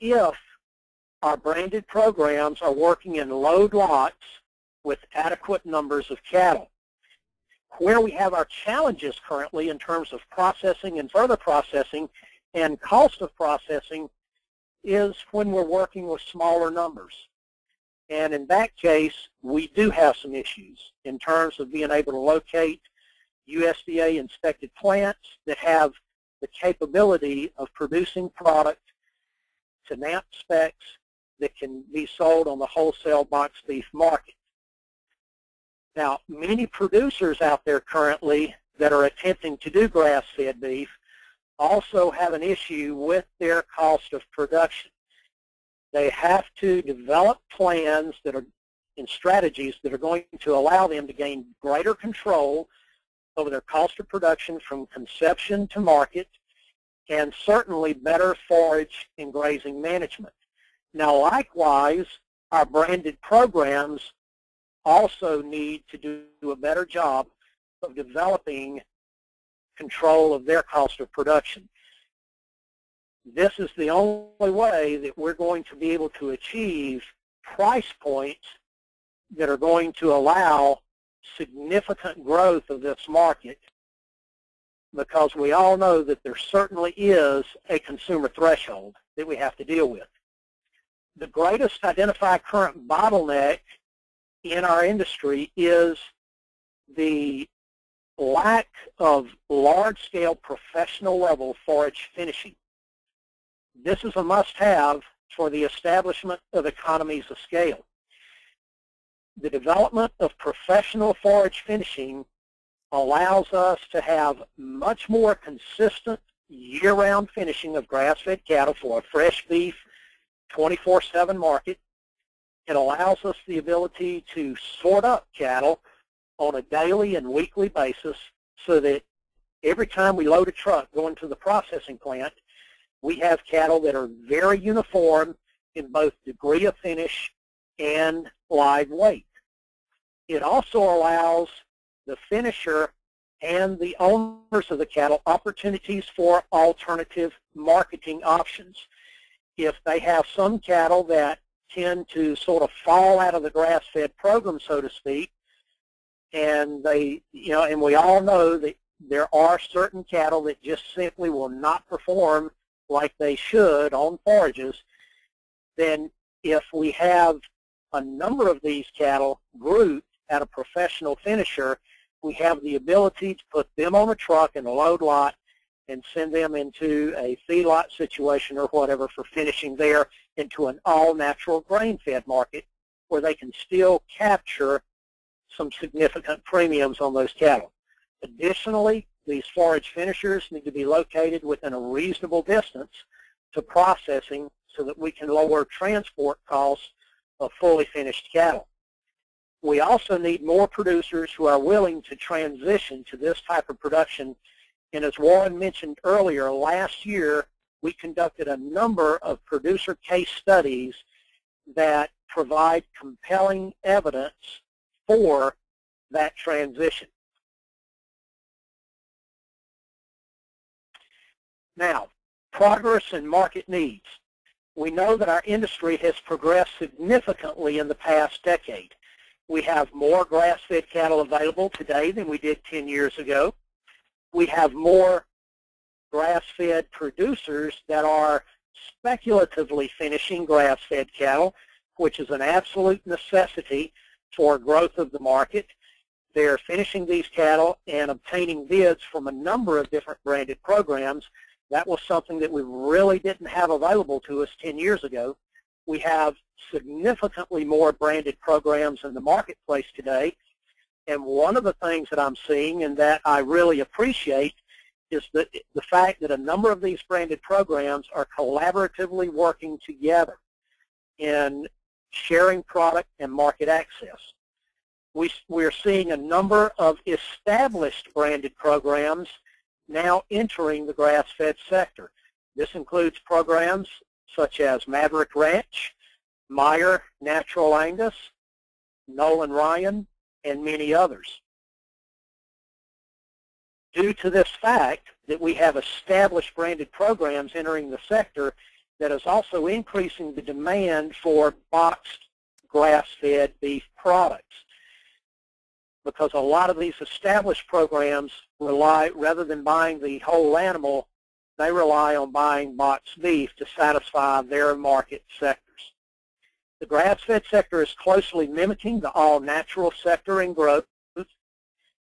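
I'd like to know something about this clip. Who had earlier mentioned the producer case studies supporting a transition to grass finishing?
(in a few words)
Warren.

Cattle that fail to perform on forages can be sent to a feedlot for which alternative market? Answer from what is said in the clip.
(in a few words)
All-natural grain-fed.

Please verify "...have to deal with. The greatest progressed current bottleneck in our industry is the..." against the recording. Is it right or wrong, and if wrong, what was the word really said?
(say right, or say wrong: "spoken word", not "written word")
wrong: "identified", not "progressed".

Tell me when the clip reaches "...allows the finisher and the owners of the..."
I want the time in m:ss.
2:20.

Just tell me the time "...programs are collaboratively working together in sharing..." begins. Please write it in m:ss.
4:27.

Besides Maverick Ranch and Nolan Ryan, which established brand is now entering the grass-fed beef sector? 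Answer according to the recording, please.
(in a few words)
Meyer Natural Angus.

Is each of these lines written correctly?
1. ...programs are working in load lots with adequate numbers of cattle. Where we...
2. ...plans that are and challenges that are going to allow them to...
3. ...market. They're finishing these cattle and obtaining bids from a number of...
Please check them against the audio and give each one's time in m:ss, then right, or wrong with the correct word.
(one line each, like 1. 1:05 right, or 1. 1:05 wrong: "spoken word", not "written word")
1. 0:01 right
2. 0:47 wrong: "strategies", not "challenges"
3. 4:05 right.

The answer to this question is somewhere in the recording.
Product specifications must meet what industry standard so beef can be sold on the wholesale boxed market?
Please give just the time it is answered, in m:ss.
0:29.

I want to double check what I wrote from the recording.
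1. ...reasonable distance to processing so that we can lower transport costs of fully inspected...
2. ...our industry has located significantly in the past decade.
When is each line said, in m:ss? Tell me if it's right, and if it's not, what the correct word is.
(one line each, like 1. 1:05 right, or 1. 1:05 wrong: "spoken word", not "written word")
1. 3:11 wrong: "finished", not "inspected"
2. 3:45 wrong: "progressed", not "located".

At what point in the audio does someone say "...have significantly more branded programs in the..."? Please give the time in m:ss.
4:16.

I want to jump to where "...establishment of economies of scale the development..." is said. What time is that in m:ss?
1:45.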